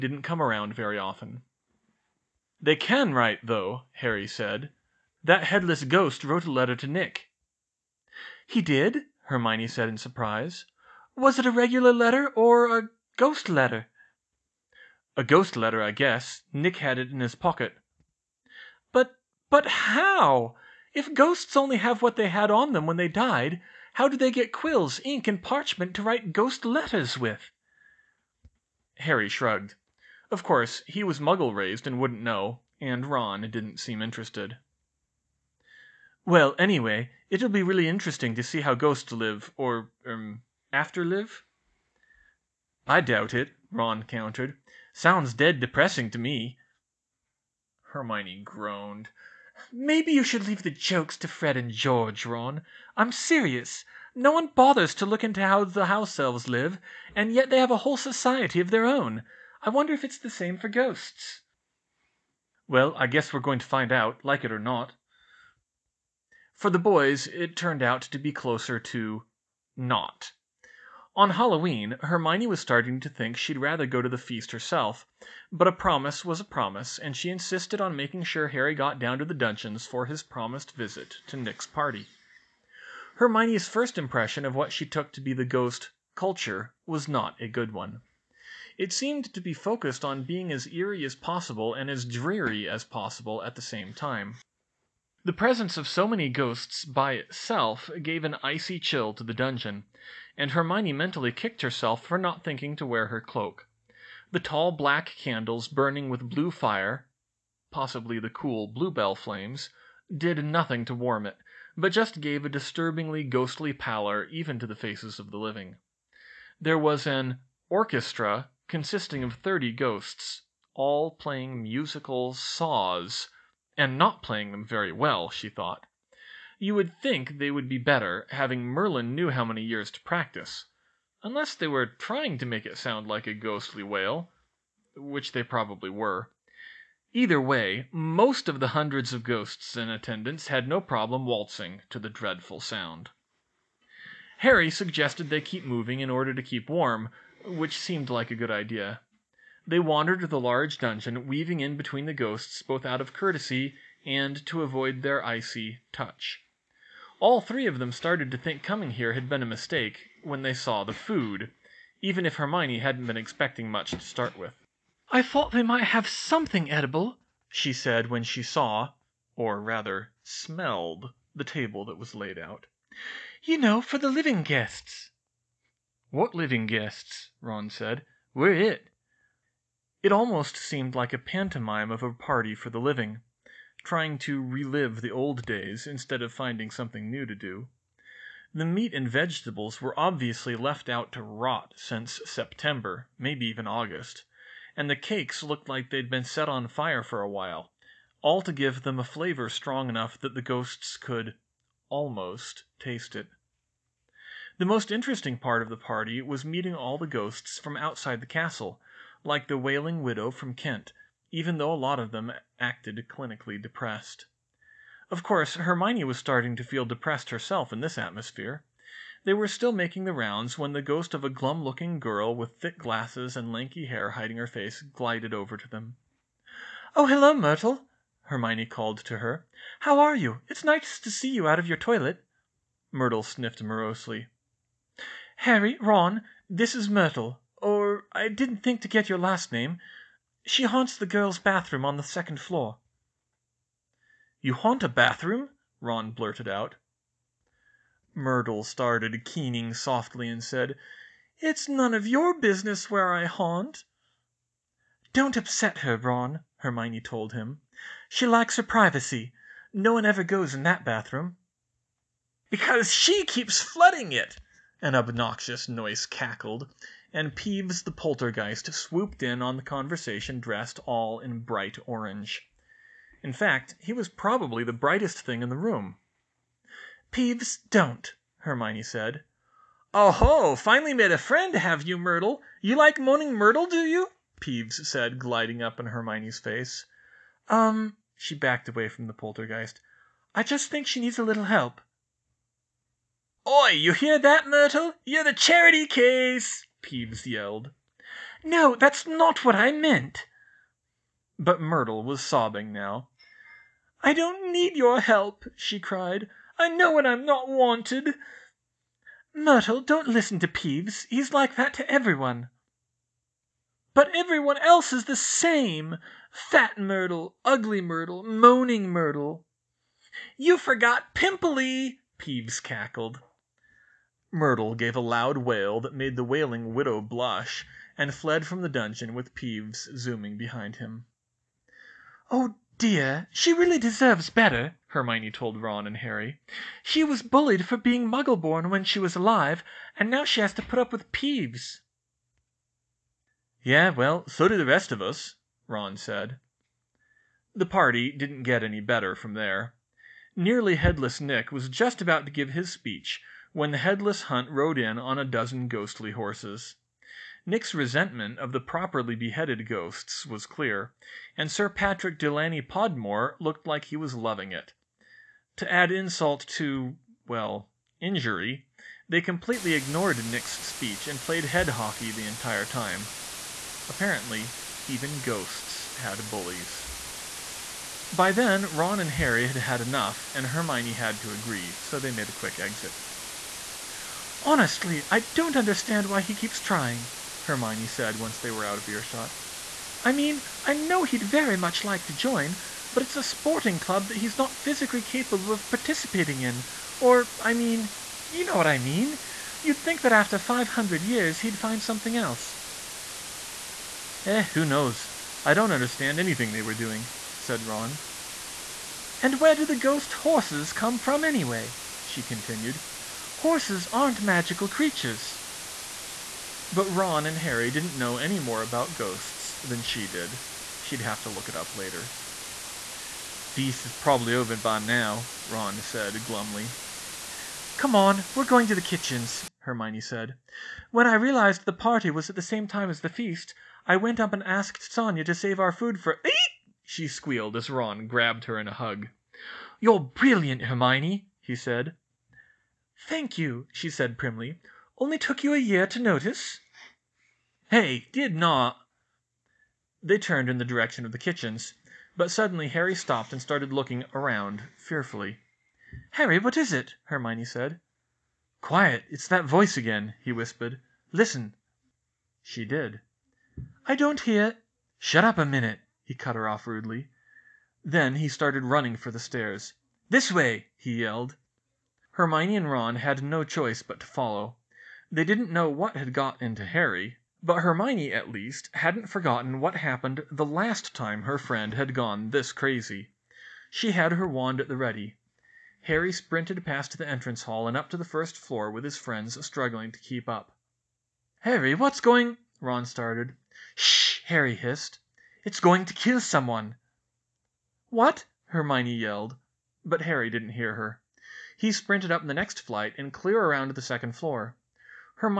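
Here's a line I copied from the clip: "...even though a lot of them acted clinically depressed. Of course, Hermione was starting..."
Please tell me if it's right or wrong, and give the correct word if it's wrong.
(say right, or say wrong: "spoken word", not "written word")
right.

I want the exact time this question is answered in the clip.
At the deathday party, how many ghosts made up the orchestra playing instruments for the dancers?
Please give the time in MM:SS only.
01:59.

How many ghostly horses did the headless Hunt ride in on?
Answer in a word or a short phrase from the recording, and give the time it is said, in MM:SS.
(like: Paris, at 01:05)
A dozen, at 05:55.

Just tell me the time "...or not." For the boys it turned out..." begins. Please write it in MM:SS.
01:04.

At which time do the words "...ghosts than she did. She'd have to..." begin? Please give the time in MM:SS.
06:58.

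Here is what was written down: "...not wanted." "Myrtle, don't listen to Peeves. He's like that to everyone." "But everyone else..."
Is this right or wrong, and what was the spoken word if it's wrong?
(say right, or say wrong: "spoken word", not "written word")
right.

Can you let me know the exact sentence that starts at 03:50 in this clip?
It's nice to see you out of your toilet." Myrtle sniffed morosely.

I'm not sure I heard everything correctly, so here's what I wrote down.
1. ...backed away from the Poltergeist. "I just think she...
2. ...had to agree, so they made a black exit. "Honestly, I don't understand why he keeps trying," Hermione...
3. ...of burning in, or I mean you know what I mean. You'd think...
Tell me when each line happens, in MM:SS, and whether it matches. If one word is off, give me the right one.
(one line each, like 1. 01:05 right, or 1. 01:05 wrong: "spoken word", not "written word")
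1. 04:48 right
2. 06:20 wrong: "quick", not "black"
3. 06:35 wrong: "participating", not "burning".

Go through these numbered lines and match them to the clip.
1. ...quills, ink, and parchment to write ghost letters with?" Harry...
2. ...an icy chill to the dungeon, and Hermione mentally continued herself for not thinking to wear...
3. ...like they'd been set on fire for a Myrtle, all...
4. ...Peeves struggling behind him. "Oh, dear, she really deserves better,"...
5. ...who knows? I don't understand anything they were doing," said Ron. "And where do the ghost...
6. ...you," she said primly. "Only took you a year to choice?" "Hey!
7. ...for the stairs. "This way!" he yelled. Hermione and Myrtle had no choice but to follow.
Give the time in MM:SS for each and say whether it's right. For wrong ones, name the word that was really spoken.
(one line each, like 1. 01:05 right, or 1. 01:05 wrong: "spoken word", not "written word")
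1. 00:24 right
2. 01:38 wrong: "kicked", not "continued"
3. 03:15 wrong: "while", not "Myrtle"
4. 05:29 wrong: "zooming", not "struggling"
5. 06:44 right
6. 07:23 wrong: "notice", not "choice"
7. 07:48 wrong: "Ron", not "Myrtle".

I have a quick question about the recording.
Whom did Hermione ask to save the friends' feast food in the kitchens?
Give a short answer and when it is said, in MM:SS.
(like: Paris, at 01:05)
Sonya, at 07:14.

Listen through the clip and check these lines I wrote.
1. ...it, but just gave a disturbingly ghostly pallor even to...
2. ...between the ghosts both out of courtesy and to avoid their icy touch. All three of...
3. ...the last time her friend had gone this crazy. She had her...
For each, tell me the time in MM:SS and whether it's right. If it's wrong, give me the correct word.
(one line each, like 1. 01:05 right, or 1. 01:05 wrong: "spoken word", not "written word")
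1. 01:51 right
2. 02:31 right
3. 08:00 right.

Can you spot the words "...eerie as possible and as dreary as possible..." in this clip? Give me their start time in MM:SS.
01:30.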